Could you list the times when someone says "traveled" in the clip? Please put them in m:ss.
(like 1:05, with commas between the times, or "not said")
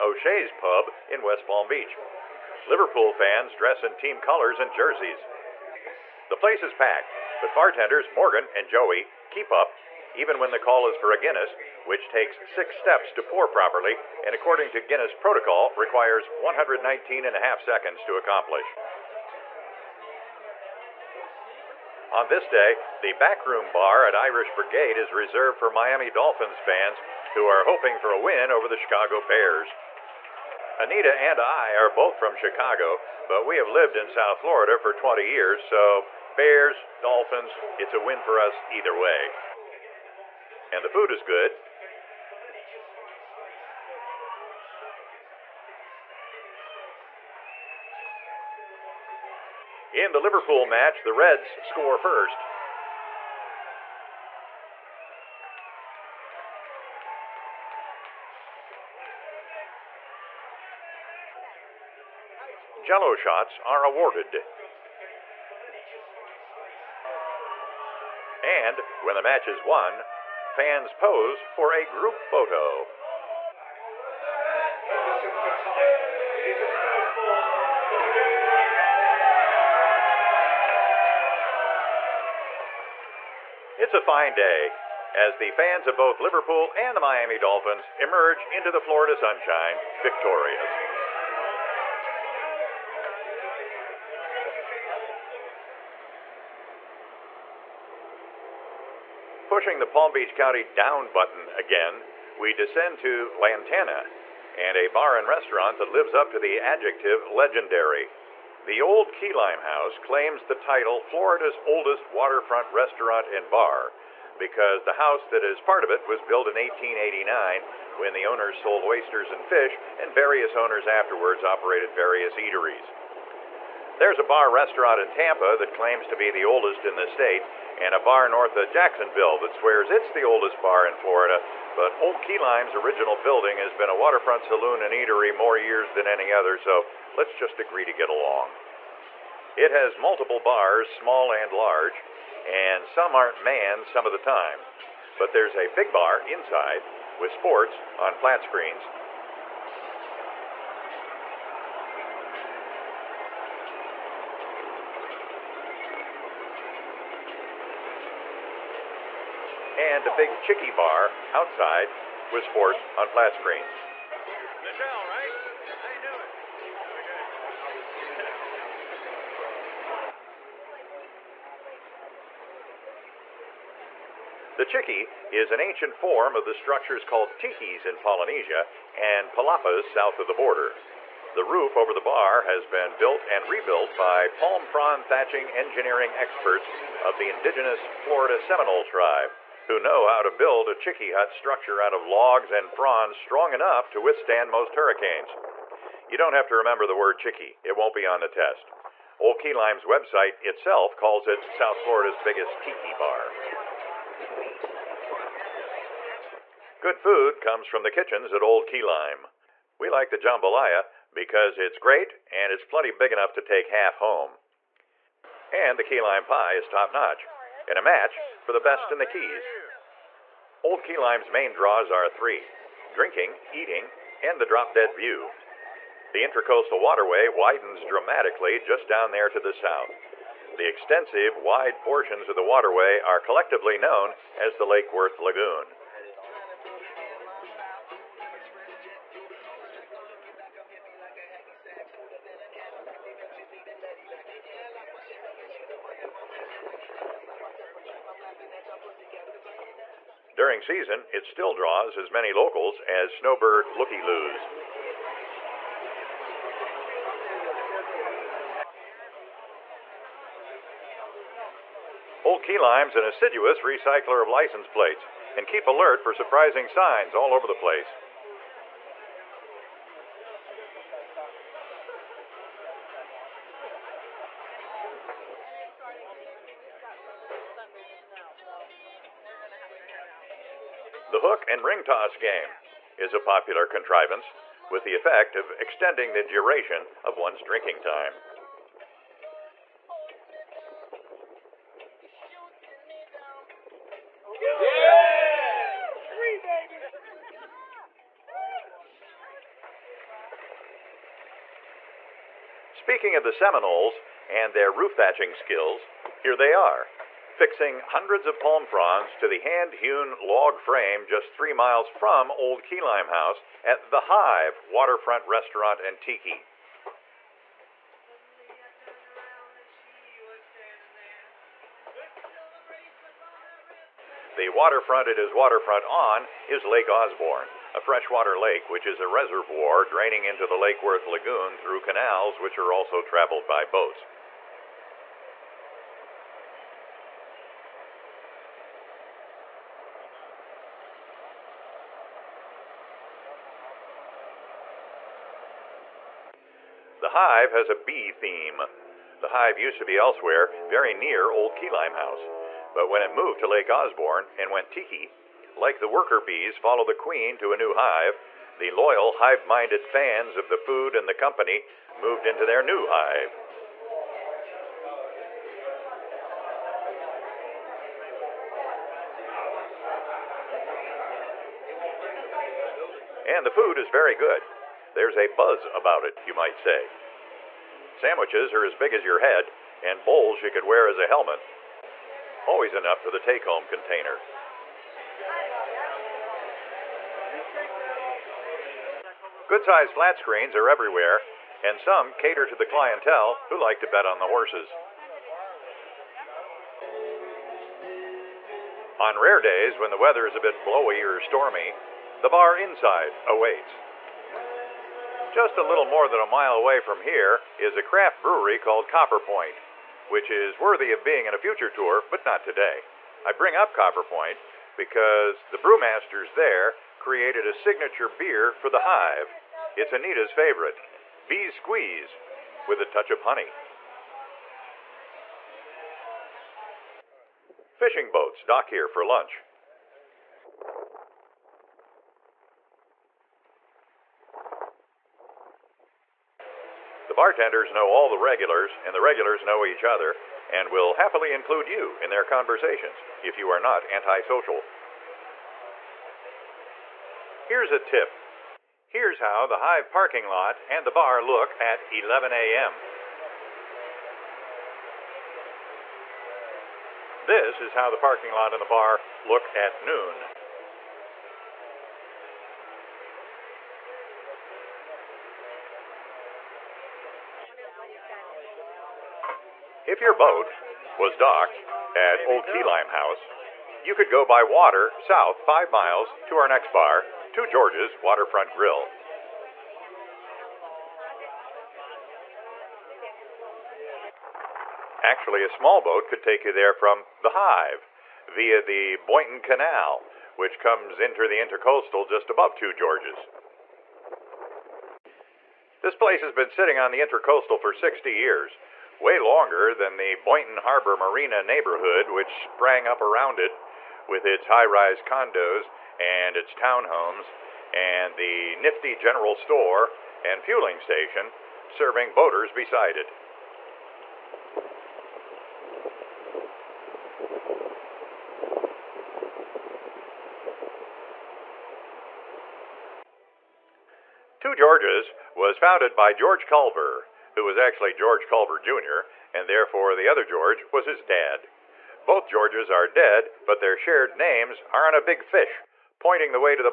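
5:33.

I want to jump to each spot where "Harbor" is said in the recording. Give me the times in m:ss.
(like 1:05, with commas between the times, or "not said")
8:20.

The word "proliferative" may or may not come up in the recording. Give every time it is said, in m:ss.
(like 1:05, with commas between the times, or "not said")
not said.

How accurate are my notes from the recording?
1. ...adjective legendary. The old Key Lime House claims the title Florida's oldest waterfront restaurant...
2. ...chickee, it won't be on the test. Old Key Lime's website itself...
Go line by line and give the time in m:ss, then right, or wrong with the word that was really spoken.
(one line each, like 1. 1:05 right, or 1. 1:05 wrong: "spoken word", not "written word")
1. 1:46 right
2. 3:17 right.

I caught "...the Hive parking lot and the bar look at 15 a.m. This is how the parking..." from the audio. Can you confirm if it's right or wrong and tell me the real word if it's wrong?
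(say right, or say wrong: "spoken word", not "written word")
wrong: "11", not "15".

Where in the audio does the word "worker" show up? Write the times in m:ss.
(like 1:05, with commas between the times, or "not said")
5:55.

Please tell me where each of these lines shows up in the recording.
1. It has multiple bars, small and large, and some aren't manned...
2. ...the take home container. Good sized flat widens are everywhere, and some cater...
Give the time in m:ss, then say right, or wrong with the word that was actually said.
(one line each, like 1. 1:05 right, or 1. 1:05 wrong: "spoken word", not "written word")
1. 2:19 right
2. 6:23 wrong: "screens", not "widens".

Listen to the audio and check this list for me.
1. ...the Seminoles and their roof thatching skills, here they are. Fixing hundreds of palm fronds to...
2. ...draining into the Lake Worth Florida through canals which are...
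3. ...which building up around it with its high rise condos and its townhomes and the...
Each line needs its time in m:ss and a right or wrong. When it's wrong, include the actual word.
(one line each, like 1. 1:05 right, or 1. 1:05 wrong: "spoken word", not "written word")
1. 5:03 right
2. 5:29 wrong: "Lagoon", not "Florida"
3. 8:22 wrong: "sprang", not "building".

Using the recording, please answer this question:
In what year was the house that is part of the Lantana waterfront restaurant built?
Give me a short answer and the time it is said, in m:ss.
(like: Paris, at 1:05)
1889, at 1:56.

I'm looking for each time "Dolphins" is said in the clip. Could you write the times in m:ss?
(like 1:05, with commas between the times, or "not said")
0:26, 0:36, 1:27.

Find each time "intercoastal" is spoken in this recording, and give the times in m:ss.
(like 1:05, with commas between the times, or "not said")
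8:11, 8:16.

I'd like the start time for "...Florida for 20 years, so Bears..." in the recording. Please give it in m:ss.
0:34.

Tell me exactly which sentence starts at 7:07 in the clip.
Fishing boats dock here for lunch.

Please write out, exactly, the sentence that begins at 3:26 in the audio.
Good food comes from the kitchens at Old Key Lime.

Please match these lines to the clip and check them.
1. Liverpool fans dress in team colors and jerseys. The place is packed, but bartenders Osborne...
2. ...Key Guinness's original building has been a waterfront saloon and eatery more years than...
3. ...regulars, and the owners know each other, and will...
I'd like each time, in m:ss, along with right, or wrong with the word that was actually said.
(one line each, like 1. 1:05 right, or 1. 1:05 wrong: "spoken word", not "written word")
1. 0:02 wrong: "Morgan", not "Osborne"
2. 2:12 wrong: "Lime", not "Guinness"
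3. 7:18 wrong: "regulars", not "owners".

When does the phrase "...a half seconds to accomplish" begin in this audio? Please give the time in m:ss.
0:17.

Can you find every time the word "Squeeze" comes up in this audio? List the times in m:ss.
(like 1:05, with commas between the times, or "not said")
7:01.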